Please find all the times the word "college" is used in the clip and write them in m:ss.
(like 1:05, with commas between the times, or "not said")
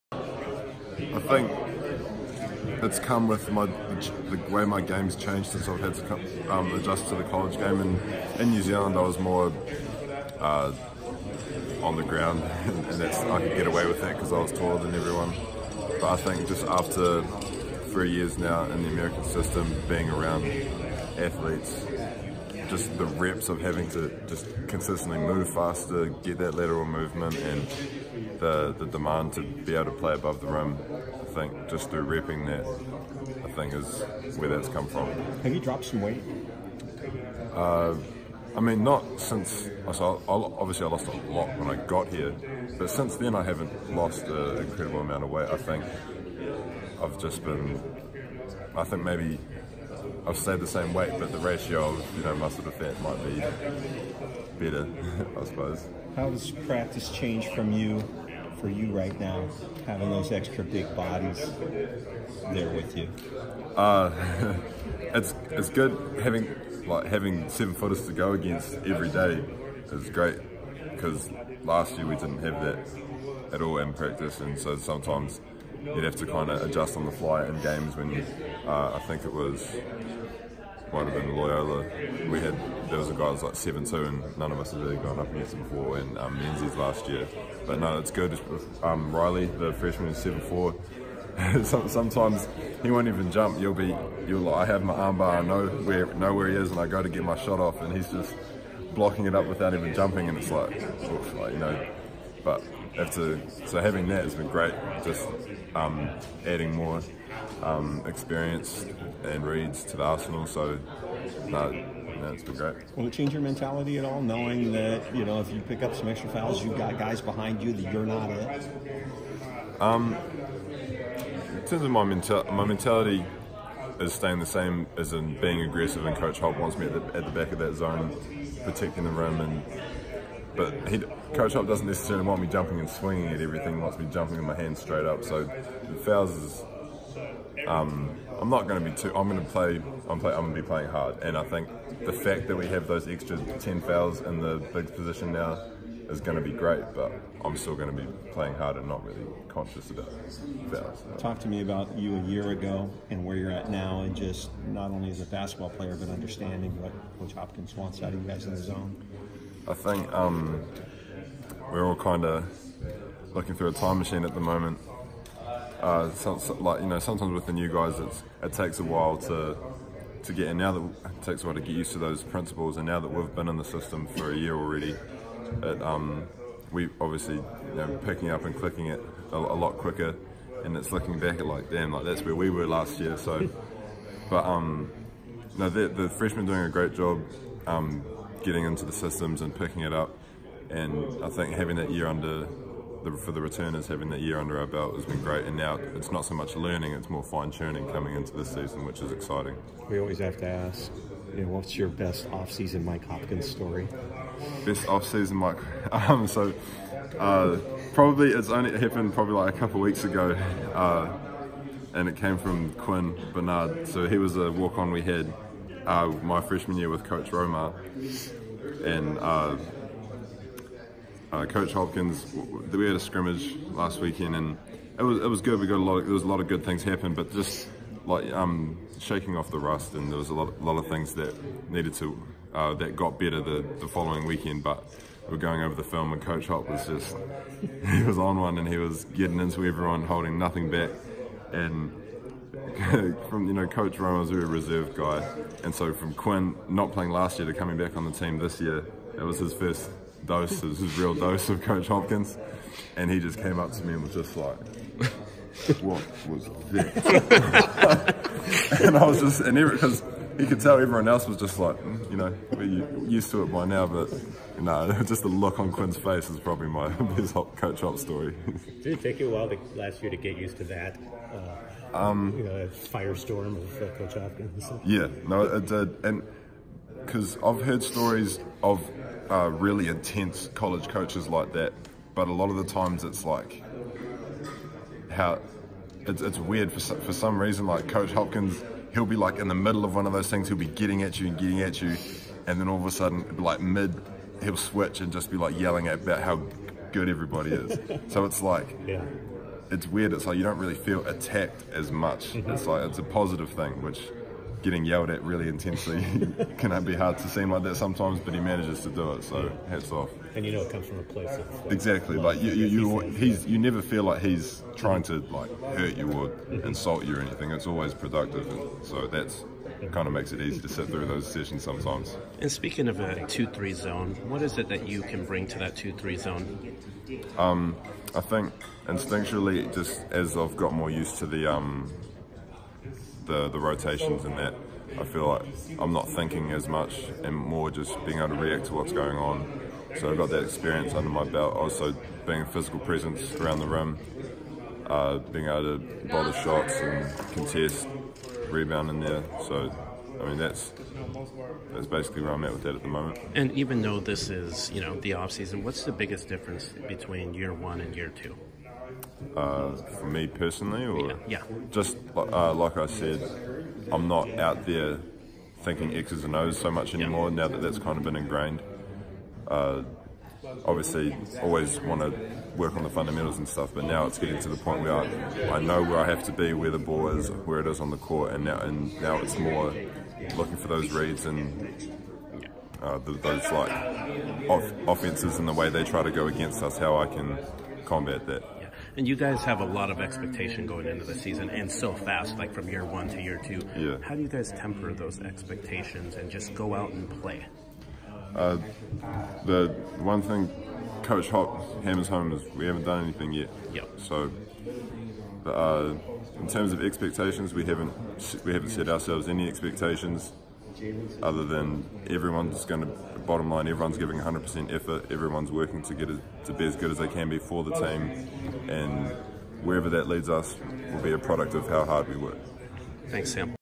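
0:07, 4:40.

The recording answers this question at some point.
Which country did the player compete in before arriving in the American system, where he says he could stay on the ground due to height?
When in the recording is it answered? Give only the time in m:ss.
0:08.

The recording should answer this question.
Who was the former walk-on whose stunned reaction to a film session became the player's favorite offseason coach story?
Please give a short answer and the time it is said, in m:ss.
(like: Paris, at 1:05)
Quinn Bernard, at 3:32.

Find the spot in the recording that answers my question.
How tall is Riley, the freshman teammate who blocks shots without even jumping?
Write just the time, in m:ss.
1:30.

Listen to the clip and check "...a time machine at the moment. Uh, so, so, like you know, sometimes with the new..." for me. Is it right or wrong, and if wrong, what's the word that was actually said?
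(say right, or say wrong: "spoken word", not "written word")
right.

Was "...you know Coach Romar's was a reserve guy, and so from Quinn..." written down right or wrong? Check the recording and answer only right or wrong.
right.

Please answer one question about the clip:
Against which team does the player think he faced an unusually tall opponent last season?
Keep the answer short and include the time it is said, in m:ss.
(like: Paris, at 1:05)
Loyola, at 1:21.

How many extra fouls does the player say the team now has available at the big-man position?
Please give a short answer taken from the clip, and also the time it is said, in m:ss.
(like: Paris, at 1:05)
10, at 2:23.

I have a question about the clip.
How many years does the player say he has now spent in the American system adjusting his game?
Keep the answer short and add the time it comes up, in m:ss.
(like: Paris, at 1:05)
3, at 0:17.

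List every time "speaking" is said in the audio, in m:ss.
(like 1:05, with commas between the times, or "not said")
5:22.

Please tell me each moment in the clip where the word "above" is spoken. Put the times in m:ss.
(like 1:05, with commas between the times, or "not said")
0:30.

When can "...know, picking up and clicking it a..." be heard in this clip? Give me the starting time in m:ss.
2:57.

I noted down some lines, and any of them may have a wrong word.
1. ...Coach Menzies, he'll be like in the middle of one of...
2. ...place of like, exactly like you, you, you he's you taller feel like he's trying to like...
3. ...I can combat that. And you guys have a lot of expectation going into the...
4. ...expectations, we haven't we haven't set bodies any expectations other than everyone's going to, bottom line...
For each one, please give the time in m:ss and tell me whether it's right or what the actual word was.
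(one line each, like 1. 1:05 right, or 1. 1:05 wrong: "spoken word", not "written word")
1. 4:47 wrong: "Hopkins", not "Menzies"
2. 5:11 wrong: "never", not "taller"
3. 6:26 right
4. 6:46 wrong: "ourselves", not "bodies".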